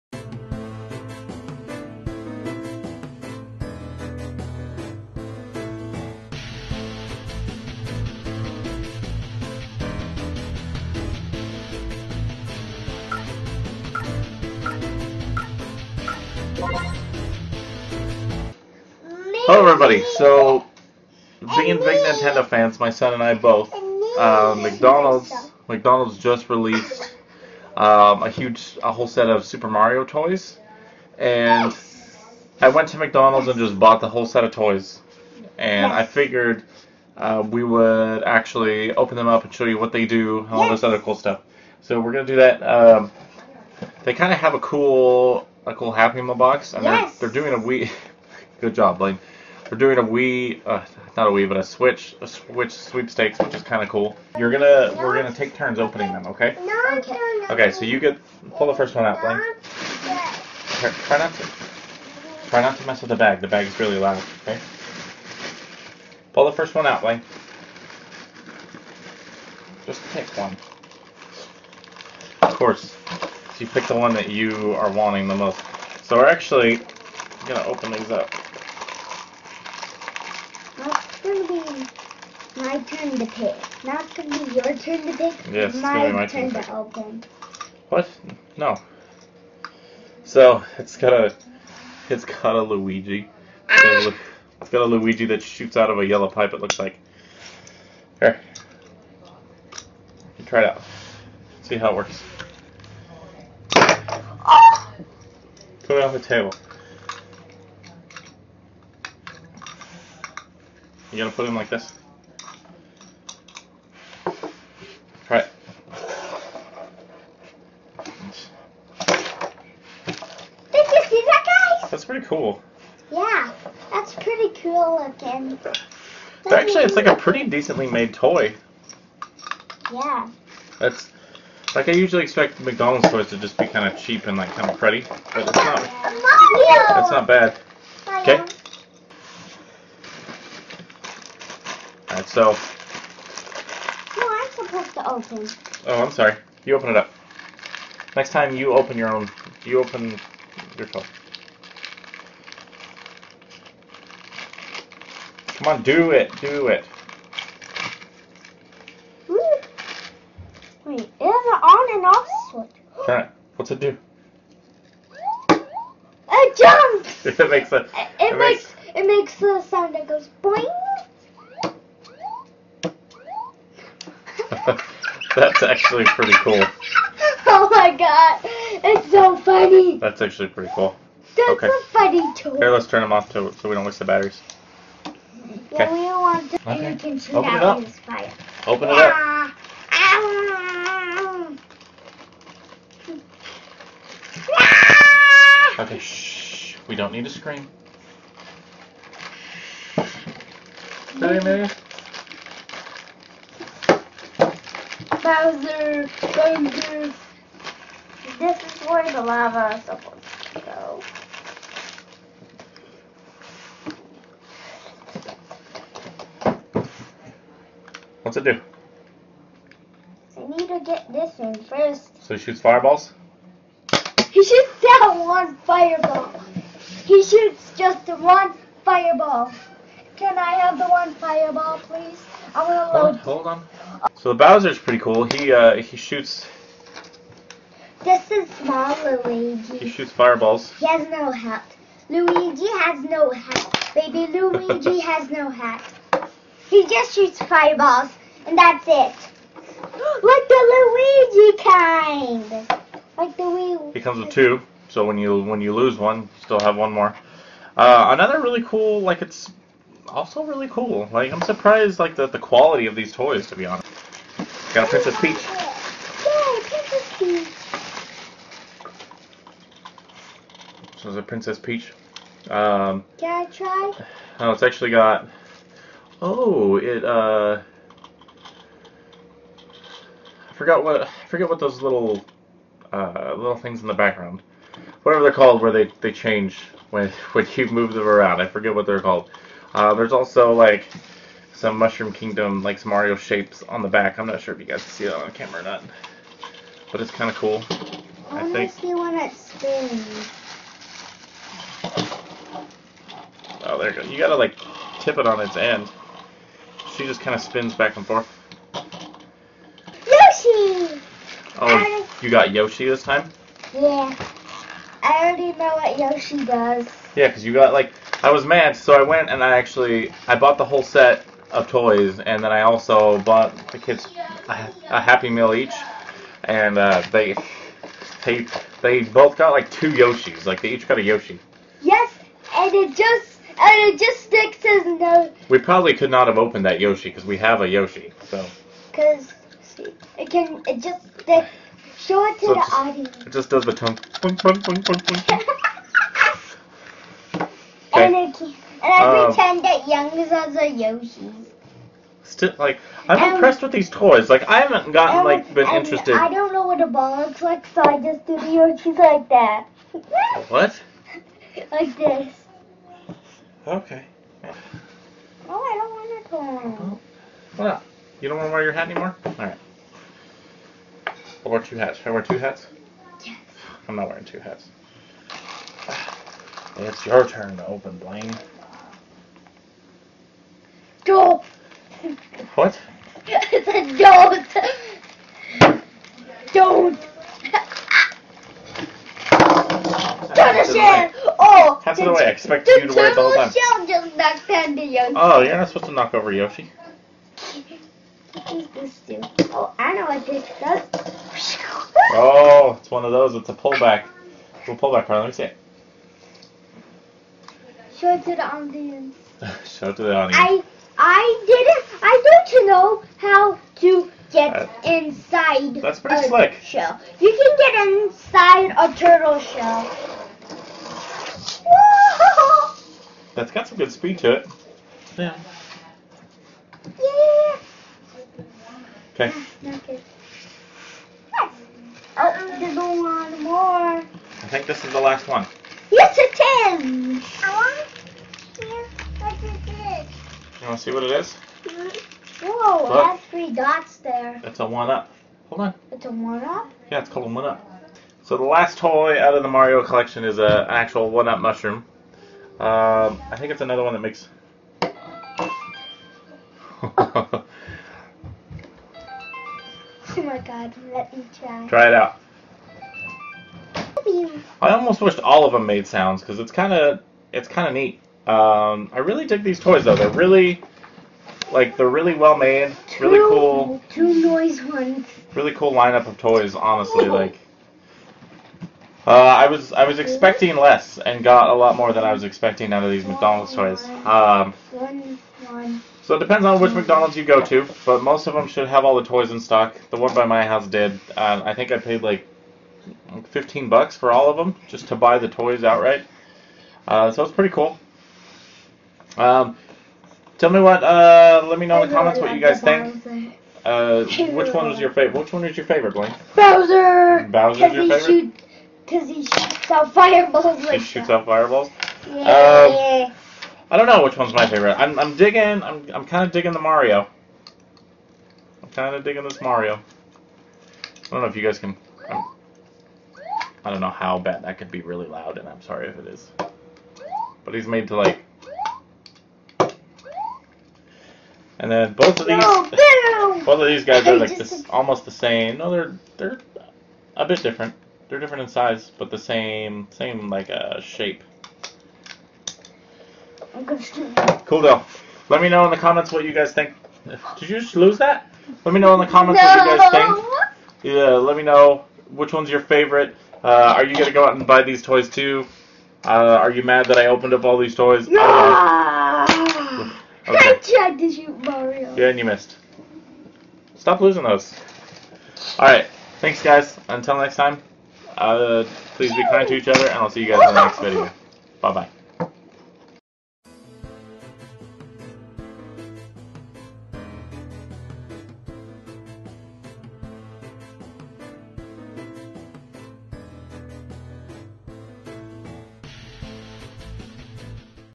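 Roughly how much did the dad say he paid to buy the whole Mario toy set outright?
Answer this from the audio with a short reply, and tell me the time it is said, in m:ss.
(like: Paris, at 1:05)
$15, at 8:13.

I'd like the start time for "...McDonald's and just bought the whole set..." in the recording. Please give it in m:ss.
0:32.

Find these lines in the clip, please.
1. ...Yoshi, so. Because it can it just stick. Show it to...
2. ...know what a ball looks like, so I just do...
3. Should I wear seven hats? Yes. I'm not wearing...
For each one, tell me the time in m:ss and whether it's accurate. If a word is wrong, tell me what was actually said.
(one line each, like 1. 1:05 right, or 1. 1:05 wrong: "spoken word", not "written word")
1. 5:37 right
2. 5:56 right
3. 6:11 wrong: "two", not "seven".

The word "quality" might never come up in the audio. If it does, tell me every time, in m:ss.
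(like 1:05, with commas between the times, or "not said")
4:22.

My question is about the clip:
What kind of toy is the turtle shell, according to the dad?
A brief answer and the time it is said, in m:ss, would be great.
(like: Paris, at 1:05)
pullback, at 6:43.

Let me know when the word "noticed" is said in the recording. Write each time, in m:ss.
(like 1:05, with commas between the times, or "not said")
not said.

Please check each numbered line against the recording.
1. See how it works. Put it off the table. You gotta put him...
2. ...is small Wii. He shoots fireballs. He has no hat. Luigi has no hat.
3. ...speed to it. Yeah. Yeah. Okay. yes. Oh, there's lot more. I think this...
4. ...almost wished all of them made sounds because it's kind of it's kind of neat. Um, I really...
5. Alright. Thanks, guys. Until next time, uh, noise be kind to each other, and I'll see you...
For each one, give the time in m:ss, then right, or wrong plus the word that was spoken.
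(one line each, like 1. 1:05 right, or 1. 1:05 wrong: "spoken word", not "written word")
1. 1:41 right
2. 3:58 wrong: "Luigi", not "Wii"
3. 7:03 right
4. 7:44 right
5. 9:25 wrong: "please", not "noise".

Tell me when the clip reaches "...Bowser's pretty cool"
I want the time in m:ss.
3:54.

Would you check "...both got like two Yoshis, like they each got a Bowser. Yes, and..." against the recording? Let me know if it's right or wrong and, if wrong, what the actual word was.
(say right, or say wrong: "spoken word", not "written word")
wrong: "Yoshi", not "Bowser".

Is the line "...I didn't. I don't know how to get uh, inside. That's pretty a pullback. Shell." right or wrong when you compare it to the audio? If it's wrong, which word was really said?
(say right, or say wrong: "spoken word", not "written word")
wrong: "slick", not "pullback".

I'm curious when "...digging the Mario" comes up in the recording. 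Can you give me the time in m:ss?
8:36.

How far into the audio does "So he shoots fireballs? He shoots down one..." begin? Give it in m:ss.
3:42.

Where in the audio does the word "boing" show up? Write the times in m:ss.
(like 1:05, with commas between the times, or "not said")
2:50.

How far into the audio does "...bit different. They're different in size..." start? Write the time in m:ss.
8:57.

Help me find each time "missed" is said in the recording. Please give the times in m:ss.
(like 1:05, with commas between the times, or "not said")
9:22.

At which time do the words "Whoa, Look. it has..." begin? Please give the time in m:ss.
7:22.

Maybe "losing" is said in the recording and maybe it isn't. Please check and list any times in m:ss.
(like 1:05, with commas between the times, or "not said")
9:24.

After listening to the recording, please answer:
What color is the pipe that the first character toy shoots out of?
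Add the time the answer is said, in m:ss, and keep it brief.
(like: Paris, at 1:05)
yellow, at 1:36.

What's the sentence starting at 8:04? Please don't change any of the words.
Um, so it depends on which McDonald's you go to, but most of them should have all the toys in stock.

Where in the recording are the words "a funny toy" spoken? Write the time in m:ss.
3:01.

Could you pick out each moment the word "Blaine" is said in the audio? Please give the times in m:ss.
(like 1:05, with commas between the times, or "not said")
0:48, 0:59, 1:07, 6:17, 8:25.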